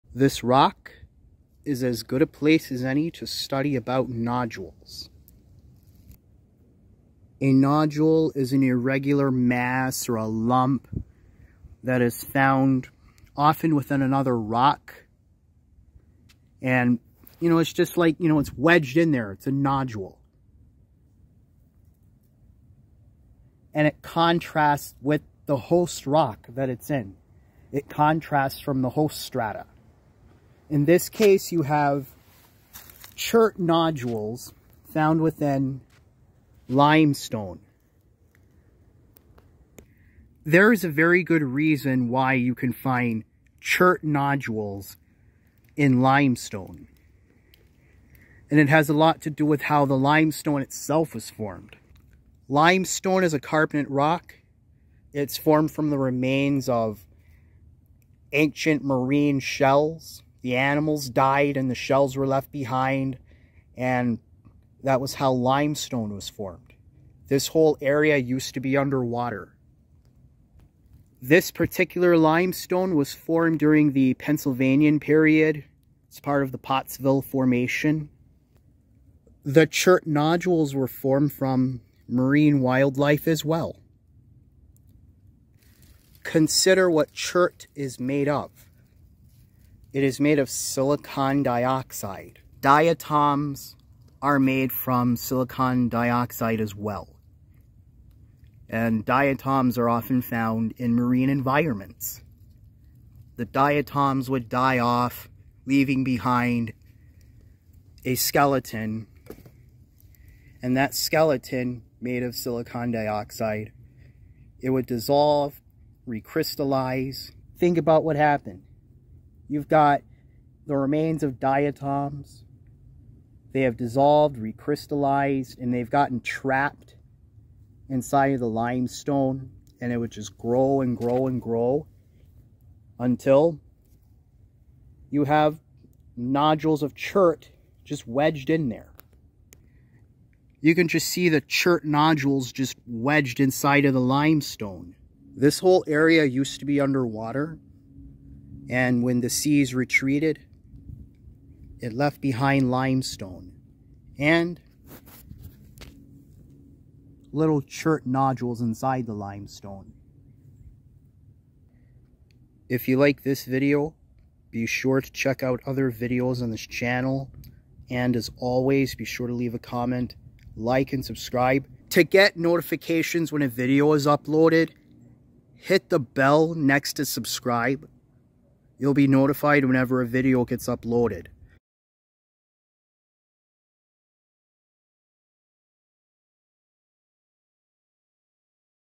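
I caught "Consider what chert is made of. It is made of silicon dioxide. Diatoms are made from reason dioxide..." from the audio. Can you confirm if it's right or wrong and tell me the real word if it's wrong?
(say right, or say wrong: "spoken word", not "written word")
wrong: "silicon", not "reason".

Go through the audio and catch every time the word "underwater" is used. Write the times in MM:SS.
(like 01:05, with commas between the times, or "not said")
01:08, 02:26.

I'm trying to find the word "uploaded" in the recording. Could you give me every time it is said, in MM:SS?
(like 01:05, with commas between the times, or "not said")
02:54, 03:00.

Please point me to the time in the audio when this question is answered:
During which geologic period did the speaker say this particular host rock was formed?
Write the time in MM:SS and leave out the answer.
01:14.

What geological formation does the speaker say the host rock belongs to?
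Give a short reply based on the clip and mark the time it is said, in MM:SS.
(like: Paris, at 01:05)
Pottsville Formation, at 01:16.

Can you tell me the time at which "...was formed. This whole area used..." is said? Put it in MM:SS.
01:06.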